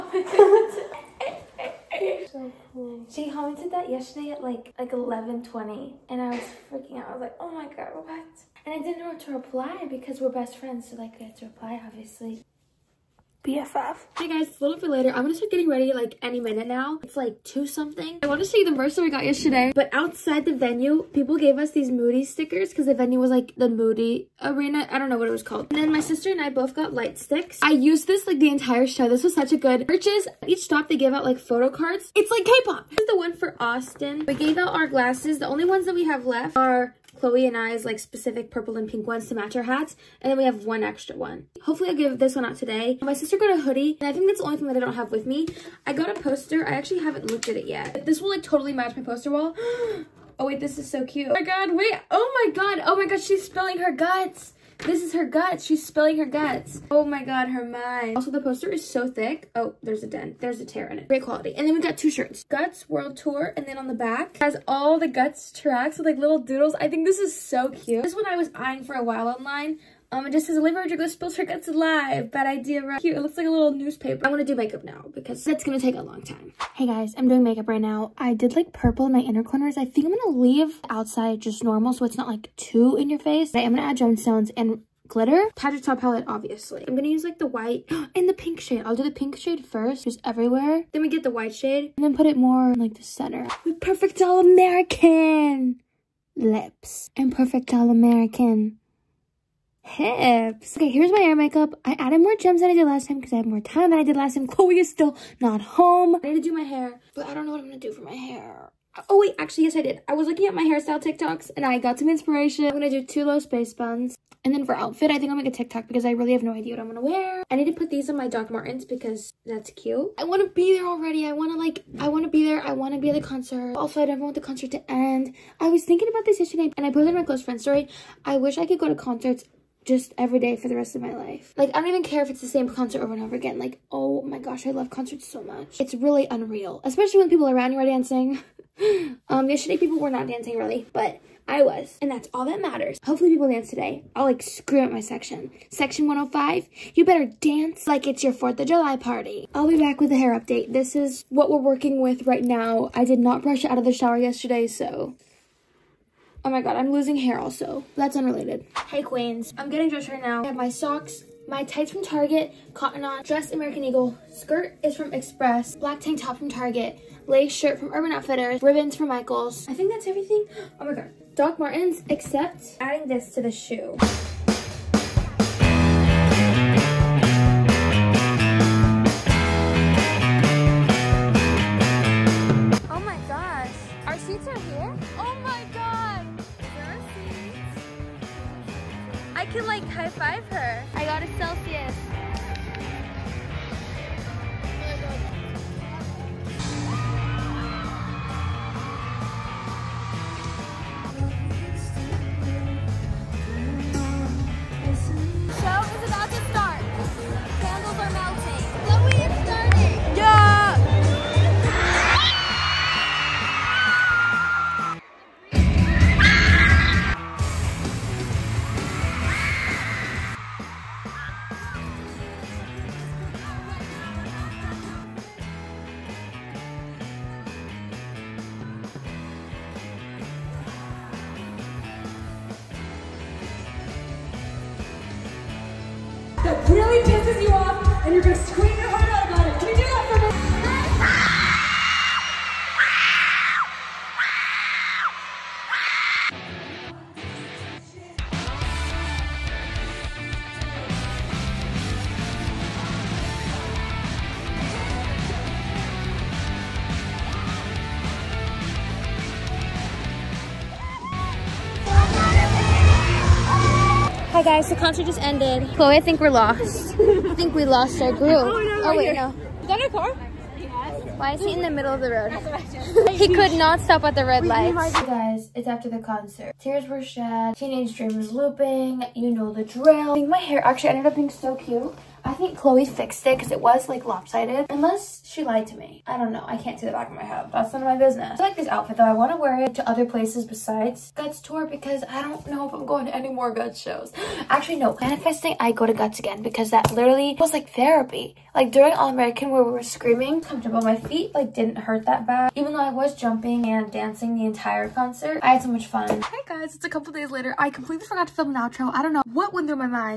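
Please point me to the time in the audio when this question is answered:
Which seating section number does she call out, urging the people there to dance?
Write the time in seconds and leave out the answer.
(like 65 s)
146 s.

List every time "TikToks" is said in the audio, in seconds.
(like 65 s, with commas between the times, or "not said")
111 s, 115 s.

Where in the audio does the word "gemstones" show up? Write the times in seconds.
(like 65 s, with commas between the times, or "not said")
84 s.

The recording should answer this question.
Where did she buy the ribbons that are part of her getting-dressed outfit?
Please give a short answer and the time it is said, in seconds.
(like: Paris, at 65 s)
Michaels, at 169 s.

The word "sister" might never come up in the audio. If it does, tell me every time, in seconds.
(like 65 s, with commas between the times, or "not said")
25 s, 43 s.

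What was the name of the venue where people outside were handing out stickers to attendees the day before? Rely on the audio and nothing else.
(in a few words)
Moody Arena.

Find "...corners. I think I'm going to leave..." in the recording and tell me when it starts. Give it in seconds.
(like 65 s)
79 s.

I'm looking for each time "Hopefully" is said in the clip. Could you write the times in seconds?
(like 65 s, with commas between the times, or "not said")
41 s, 143 s.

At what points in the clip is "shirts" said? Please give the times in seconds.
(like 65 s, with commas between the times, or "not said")
62 s, 167 s.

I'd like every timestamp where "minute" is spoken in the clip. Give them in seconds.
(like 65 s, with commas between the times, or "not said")
16 s.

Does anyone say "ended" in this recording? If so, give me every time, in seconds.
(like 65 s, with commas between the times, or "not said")
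265 s, 280 s.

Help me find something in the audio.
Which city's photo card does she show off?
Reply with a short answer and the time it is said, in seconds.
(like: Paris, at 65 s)
Austin, at 33 s.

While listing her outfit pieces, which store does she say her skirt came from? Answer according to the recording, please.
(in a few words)
Express.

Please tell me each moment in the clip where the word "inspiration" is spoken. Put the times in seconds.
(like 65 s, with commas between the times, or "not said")
112 s.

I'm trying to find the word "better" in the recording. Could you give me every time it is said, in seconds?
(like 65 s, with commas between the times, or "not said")
147 s.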